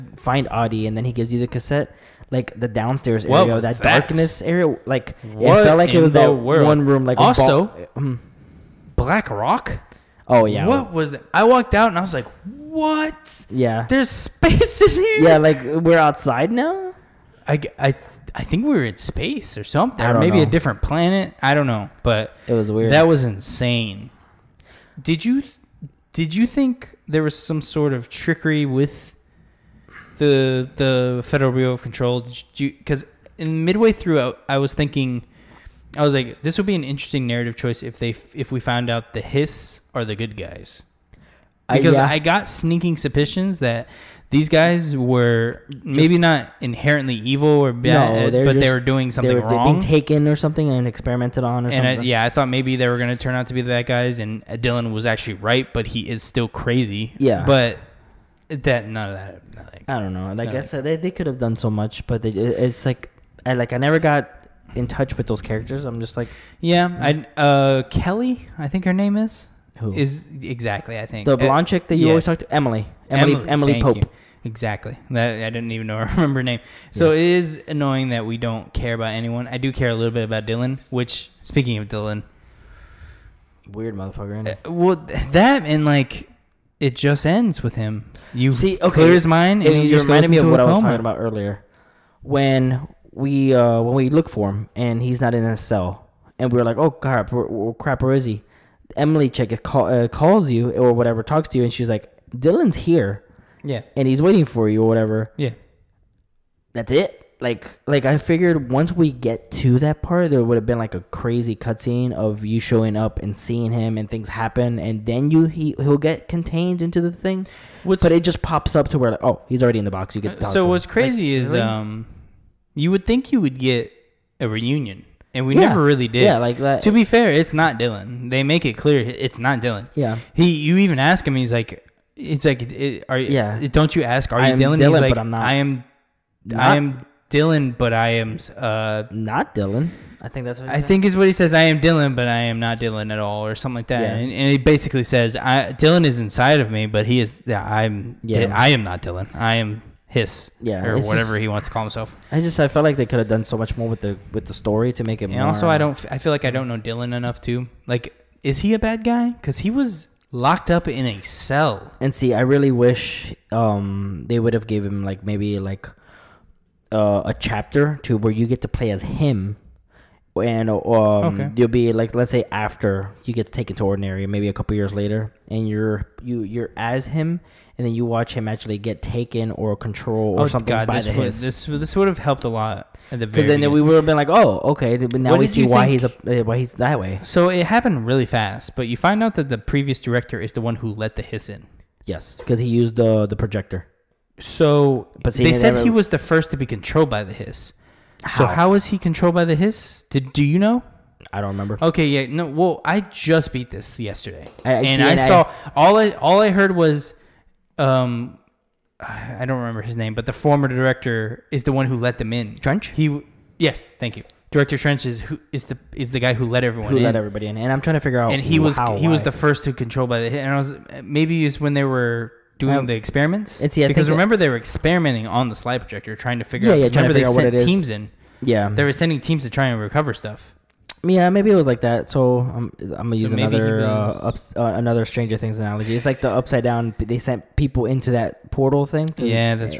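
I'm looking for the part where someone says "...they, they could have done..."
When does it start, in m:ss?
1:00.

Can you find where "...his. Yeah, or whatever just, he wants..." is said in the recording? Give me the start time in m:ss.
2:30.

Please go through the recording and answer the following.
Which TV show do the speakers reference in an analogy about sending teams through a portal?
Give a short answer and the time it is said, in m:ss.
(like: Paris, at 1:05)
Stranger Things, at 3:55.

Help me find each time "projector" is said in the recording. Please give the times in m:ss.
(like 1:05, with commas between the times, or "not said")
3:13, 3:45.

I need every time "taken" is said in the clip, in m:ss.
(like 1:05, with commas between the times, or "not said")
0:49, 2:53, 2:59.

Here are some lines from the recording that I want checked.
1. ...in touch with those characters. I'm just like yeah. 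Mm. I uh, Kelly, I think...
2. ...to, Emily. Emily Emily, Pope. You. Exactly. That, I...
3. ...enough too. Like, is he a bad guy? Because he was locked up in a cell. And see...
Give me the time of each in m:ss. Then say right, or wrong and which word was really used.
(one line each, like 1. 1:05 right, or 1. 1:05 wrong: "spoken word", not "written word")
1. 1:04 right
2. 1:12 right
3. 2:37 right.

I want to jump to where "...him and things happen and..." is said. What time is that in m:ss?
1:53.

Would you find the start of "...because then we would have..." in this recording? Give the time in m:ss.
3:03.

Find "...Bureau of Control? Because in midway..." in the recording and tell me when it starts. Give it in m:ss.
0:31.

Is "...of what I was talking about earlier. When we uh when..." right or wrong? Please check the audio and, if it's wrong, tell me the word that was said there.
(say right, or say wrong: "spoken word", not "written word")
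right.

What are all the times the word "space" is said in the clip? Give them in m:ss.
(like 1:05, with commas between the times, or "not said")
0:14, 0:18.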